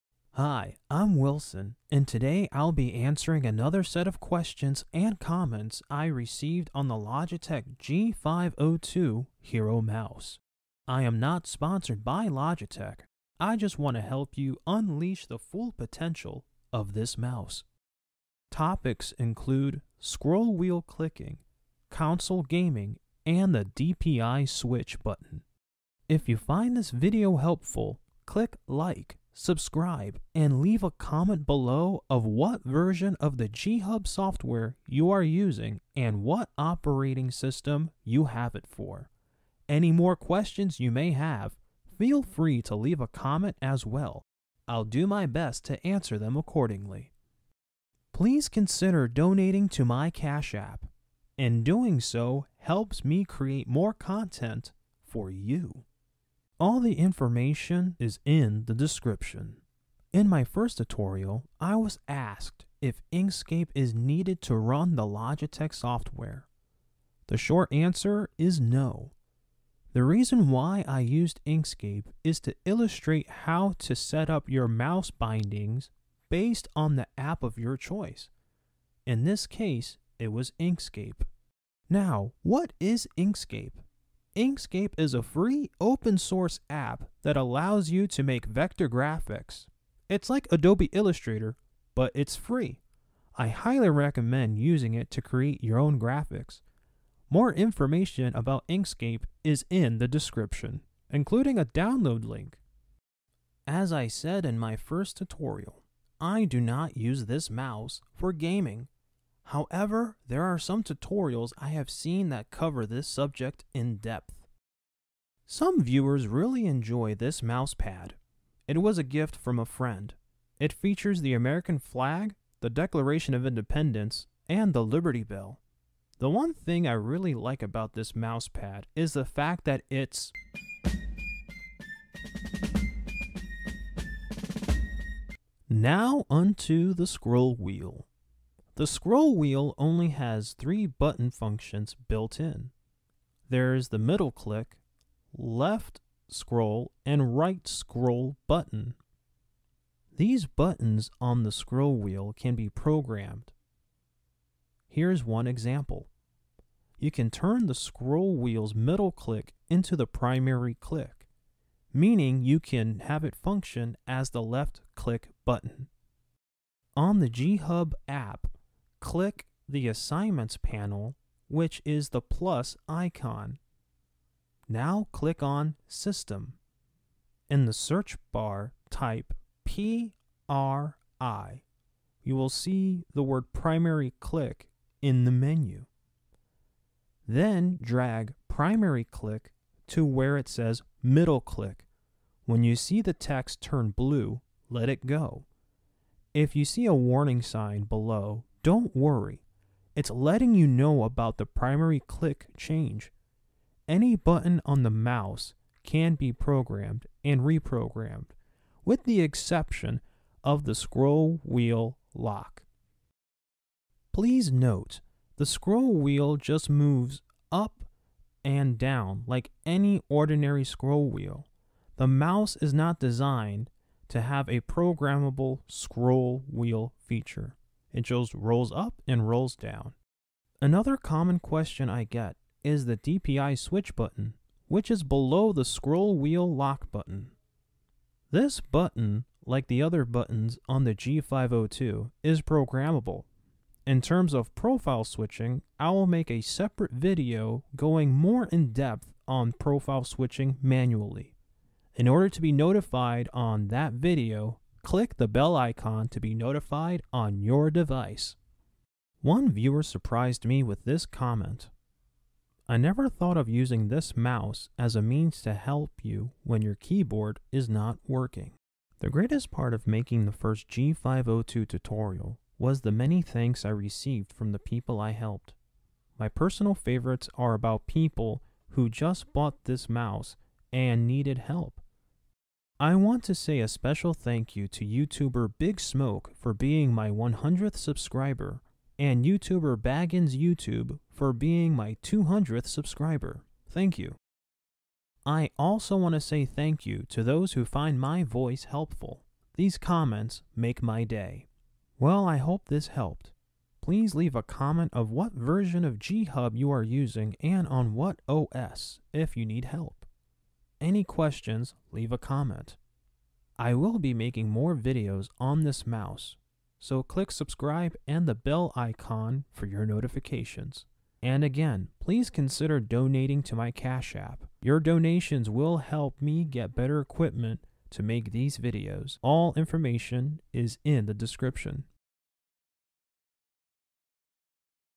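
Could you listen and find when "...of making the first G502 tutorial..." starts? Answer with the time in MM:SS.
04:29.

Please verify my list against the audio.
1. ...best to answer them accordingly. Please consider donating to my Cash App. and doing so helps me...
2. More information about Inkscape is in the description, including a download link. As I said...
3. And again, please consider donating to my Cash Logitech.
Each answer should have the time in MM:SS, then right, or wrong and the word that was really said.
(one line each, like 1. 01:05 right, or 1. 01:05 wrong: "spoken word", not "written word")
1. 00:45 right
2. 01:37 right
3. 05:21 wrong: "App", not "Logitech".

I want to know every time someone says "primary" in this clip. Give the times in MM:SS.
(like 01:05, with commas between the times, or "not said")
02:40, 03:03, 03:08, 03:21.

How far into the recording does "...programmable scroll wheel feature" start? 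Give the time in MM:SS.
03:44.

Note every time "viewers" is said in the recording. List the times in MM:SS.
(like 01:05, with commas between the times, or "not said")
01:55, 04:19.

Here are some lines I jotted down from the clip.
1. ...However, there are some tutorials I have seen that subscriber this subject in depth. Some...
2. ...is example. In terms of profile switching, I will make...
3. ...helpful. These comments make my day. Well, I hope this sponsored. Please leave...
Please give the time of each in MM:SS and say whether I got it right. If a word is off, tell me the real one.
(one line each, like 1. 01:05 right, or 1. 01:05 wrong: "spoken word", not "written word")
1. 01:49 wrong: "cover", not "subscriber"
2. 04:02 wrong: "programmable", not "example"
3. 04:58 wrong: "helped", not "sponsored".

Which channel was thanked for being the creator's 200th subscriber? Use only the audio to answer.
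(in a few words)
Baggins YouTube.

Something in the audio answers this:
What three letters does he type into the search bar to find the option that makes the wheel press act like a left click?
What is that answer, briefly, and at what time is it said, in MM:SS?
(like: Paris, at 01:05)
PRI, at 02:59.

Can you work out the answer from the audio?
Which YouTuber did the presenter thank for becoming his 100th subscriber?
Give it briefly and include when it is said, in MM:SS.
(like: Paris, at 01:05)
Big Smoke, at 04:45.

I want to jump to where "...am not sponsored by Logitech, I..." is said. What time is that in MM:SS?
00:11.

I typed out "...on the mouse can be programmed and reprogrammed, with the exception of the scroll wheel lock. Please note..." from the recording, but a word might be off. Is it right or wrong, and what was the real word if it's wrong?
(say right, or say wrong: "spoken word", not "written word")
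right.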